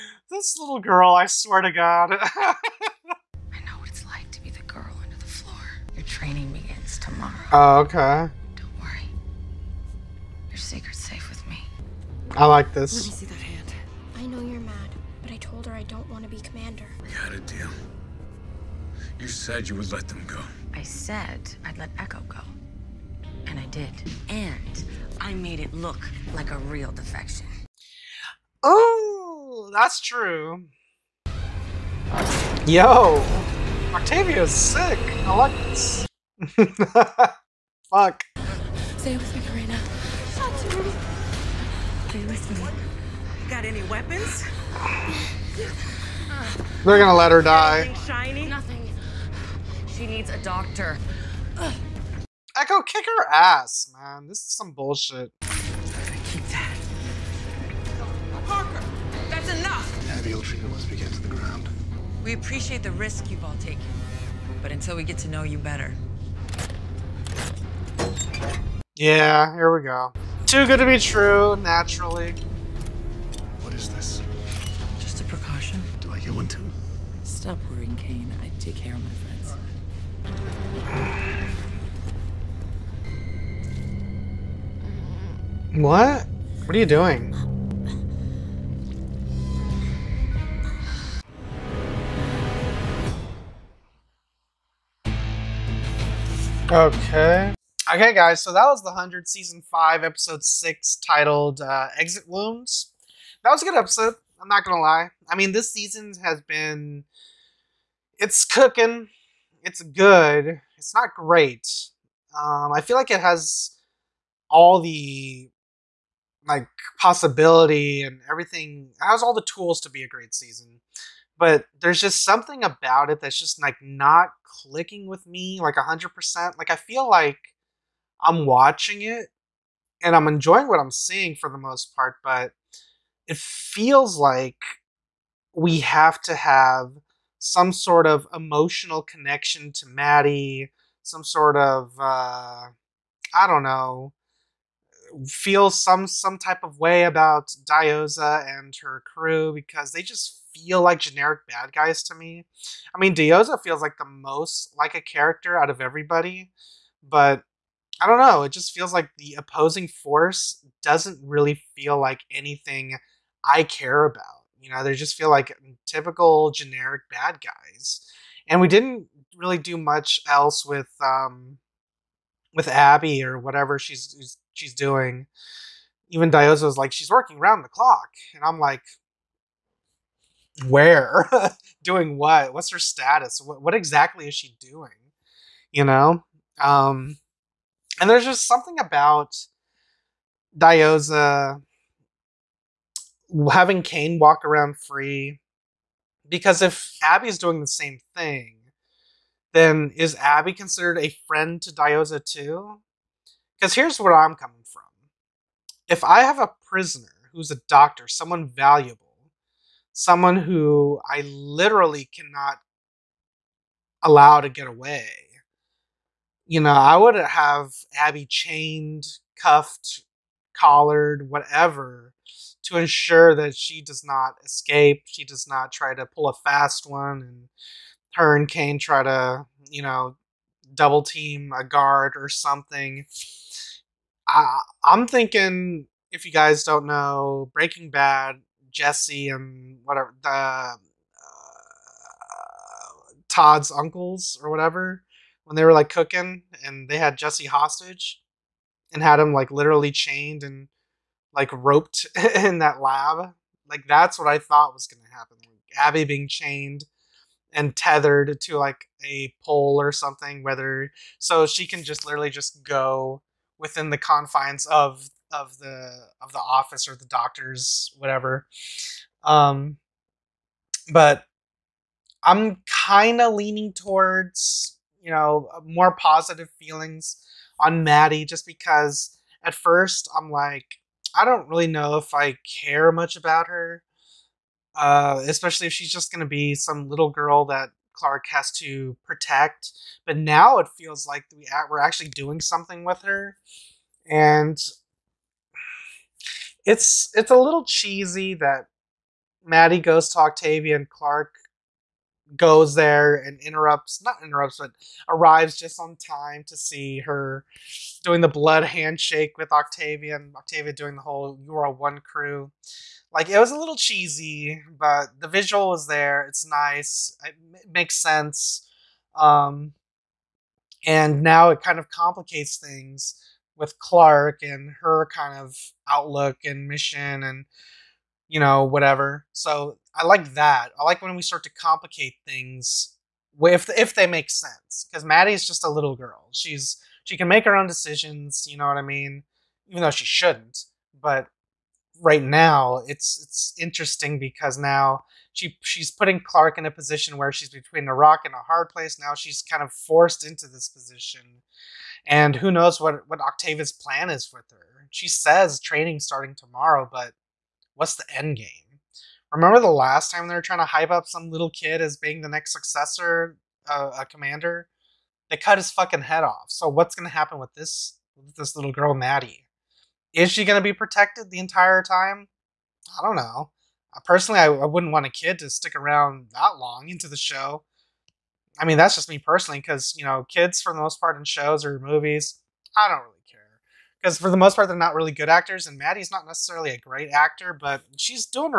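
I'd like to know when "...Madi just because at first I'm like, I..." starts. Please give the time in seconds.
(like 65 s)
277 s.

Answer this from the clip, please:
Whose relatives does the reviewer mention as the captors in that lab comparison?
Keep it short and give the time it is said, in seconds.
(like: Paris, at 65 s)
Todd's uncles, at 243 s.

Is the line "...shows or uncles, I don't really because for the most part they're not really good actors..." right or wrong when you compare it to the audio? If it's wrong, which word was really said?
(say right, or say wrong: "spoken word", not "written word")
wrong: "movies", not "uncles".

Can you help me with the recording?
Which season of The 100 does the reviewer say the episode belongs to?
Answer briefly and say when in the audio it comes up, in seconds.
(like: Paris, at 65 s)
5, at 99 s.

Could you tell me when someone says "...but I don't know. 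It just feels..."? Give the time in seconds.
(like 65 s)
157 s.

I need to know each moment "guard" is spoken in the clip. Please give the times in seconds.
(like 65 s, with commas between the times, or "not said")
231 s.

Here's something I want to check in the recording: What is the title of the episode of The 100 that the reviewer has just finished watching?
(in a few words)
Exit Wounds.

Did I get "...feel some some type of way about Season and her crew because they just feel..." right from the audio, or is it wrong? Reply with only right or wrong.
wrong.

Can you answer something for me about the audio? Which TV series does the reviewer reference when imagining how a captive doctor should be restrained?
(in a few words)
Breaking Bad.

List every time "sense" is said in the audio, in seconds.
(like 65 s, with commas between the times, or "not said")
318 s, 334 s.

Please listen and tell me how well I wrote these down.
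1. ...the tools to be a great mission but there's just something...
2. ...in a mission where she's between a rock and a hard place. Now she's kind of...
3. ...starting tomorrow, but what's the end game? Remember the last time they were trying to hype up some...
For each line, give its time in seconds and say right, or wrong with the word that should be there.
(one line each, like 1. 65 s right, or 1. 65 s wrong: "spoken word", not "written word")
1. 119 s wrong: "season", not "mission"
2. 346 s wrong: "position", not "mission"
3. 356 s right.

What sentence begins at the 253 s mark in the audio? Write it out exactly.
Like that's what I thought was gonna happen.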